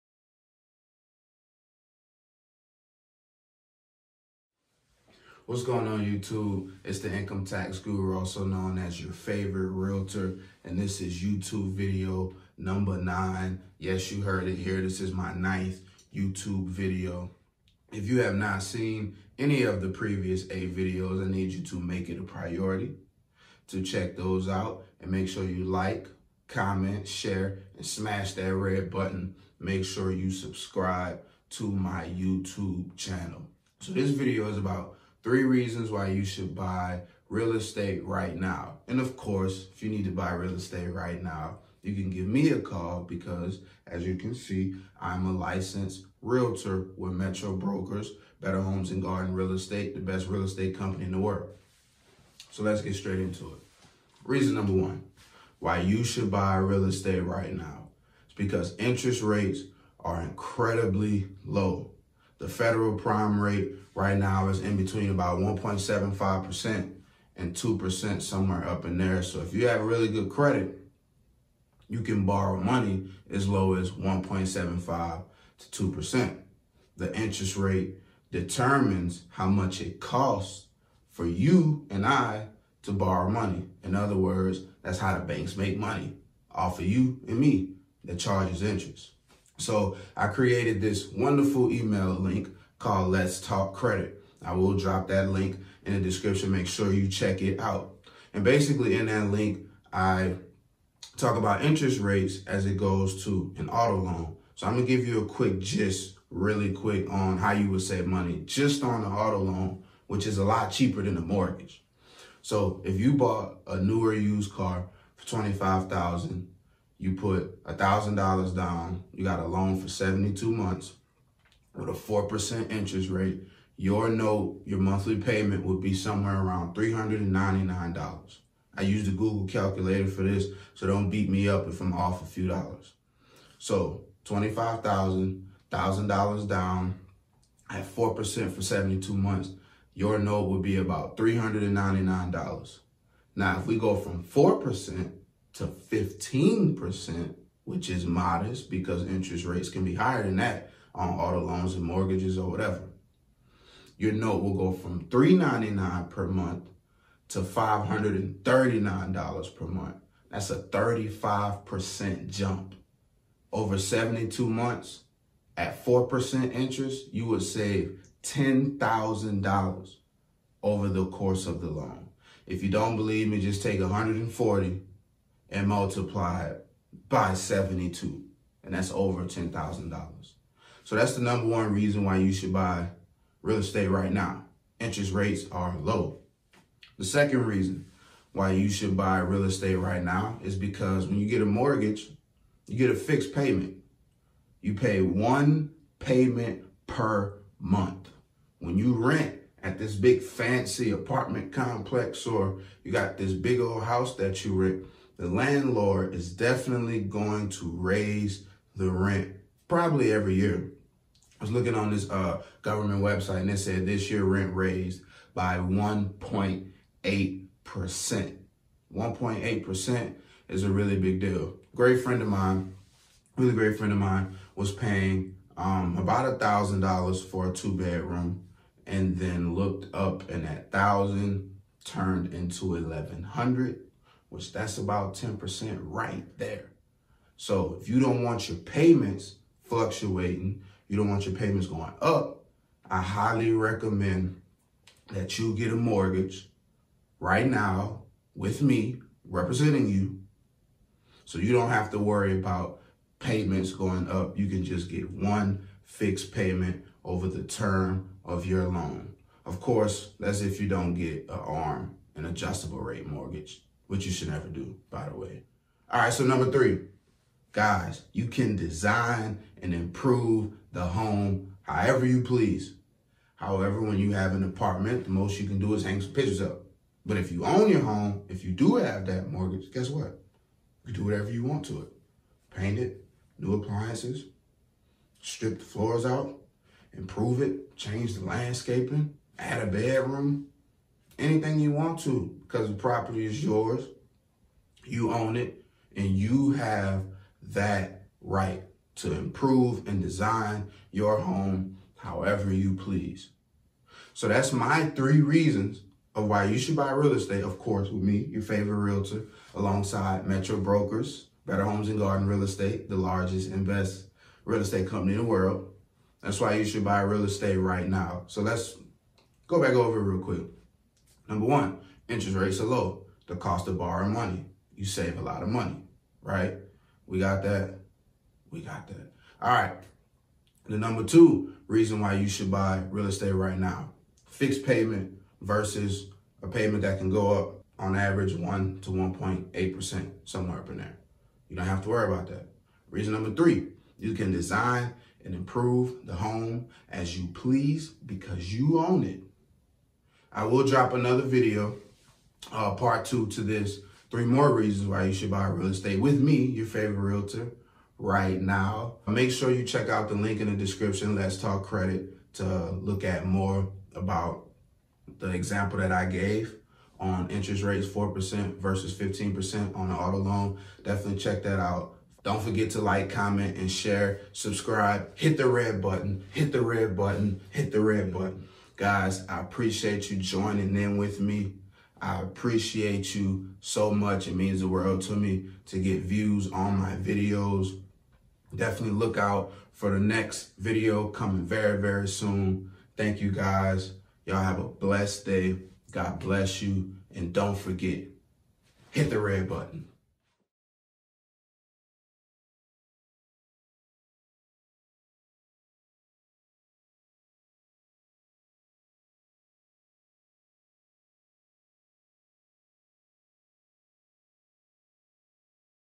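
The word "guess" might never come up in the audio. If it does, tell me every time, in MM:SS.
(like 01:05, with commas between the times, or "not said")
04:39.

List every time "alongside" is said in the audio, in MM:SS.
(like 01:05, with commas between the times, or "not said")
05:09.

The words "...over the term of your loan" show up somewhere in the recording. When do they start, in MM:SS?
04:17.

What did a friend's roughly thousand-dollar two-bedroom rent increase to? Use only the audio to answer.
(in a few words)
1100.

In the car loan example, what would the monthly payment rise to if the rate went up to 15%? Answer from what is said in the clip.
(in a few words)
$539.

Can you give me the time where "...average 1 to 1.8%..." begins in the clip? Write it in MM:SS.
05:37.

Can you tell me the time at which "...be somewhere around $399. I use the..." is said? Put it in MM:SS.
02:05.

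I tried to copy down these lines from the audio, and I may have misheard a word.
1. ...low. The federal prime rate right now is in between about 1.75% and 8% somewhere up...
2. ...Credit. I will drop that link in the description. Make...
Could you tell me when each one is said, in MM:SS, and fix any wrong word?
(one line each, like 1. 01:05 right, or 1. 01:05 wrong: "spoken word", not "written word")
1. 01:01 wrong: "2", not "8"
2. 01:33 right.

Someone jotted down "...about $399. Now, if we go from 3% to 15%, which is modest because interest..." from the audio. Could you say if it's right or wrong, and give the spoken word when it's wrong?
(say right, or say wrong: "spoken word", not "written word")
wrong: "4", not "3".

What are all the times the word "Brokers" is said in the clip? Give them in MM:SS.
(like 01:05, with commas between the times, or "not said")
00:47, 05:10.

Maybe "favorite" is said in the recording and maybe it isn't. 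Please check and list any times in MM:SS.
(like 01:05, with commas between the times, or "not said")
00:09, 05:08, 05:56.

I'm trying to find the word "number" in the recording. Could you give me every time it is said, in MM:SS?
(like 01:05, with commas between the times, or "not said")
00:12, 00:54, 03:01, 04:26, 05:21, 05:30, 05:43.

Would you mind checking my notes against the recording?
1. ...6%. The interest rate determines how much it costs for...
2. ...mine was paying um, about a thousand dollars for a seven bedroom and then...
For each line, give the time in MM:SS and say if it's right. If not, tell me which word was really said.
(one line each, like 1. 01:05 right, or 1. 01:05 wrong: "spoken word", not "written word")
1. 01:15 wrong: "2", not "6"
2. 03:43 wrong: "two", not "seven".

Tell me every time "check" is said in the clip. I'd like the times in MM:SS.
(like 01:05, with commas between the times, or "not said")
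00:23, 01:37, 05:59, 06:11.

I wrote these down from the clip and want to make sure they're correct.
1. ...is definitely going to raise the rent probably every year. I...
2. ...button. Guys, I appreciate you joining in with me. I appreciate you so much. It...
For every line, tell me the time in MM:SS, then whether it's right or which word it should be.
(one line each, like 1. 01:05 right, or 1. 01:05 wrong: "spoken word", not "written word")
1. 03:26 right
2. 06:18 right.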